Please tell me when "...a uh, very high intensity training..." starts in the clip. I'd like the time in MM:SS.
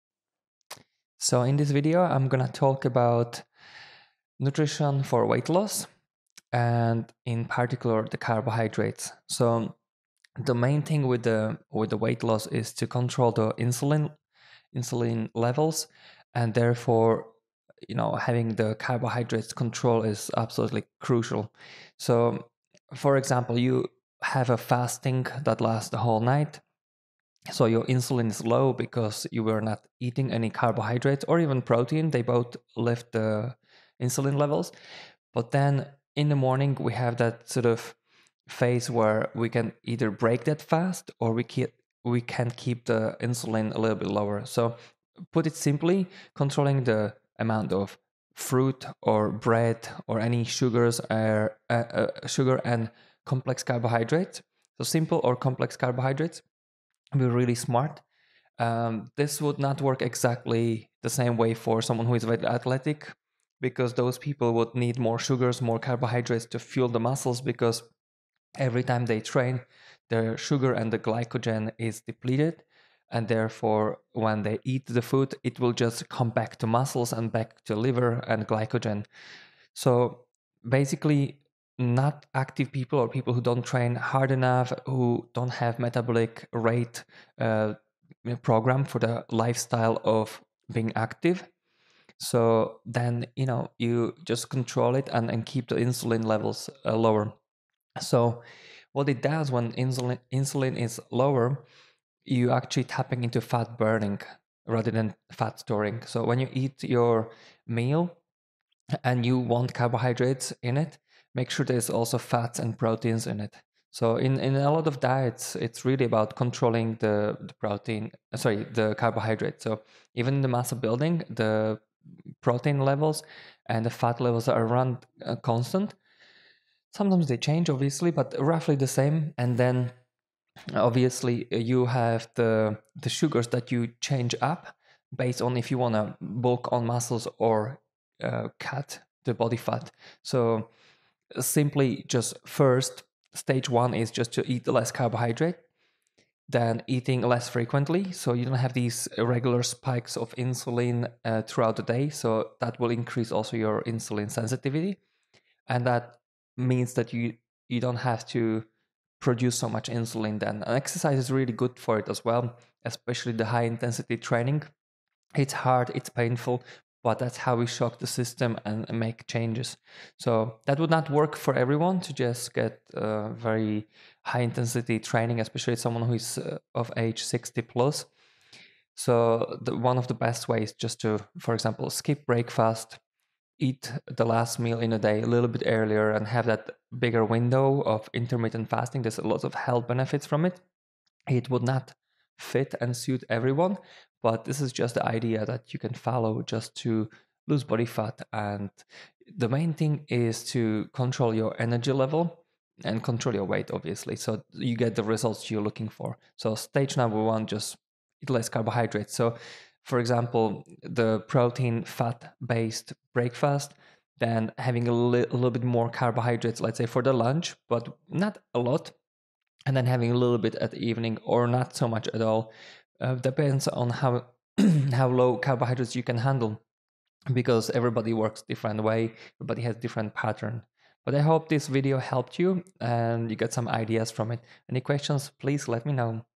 02:52.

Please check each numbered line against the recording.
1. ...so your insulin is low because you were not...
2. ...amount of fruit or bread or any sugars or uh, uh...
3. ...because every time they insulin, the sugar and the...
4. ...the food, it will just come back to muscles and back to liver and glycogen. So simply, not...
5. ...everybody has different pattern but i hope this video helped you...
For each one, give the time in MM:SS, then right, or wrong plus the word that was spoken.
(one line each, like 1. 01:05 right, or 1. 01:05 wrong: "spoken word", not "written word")
1. 00:27 right
2. 00:47 right
3. 01:07 wrong: "train", not "insulin"
4. 01:14 wrong: "basically", not "simply"
5. 03:49 right.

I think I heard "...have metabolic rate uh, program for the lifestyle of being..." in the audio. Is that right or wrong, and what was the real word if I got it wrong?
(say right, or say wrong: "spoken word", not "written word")
right.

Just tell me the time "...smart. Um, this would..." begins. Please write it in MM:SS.
00:57.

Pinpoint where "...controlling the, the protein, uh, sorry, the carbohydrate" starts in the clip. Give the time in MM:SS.
01:56.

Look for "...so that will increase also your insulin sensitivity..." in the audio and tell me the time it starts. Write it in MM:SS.
02:32.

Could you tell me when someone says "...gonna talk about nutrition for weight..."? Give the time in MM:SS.
00:02.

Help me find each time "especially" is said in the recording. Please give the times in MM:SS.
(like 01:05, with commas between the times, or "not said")
02:42, 02:55.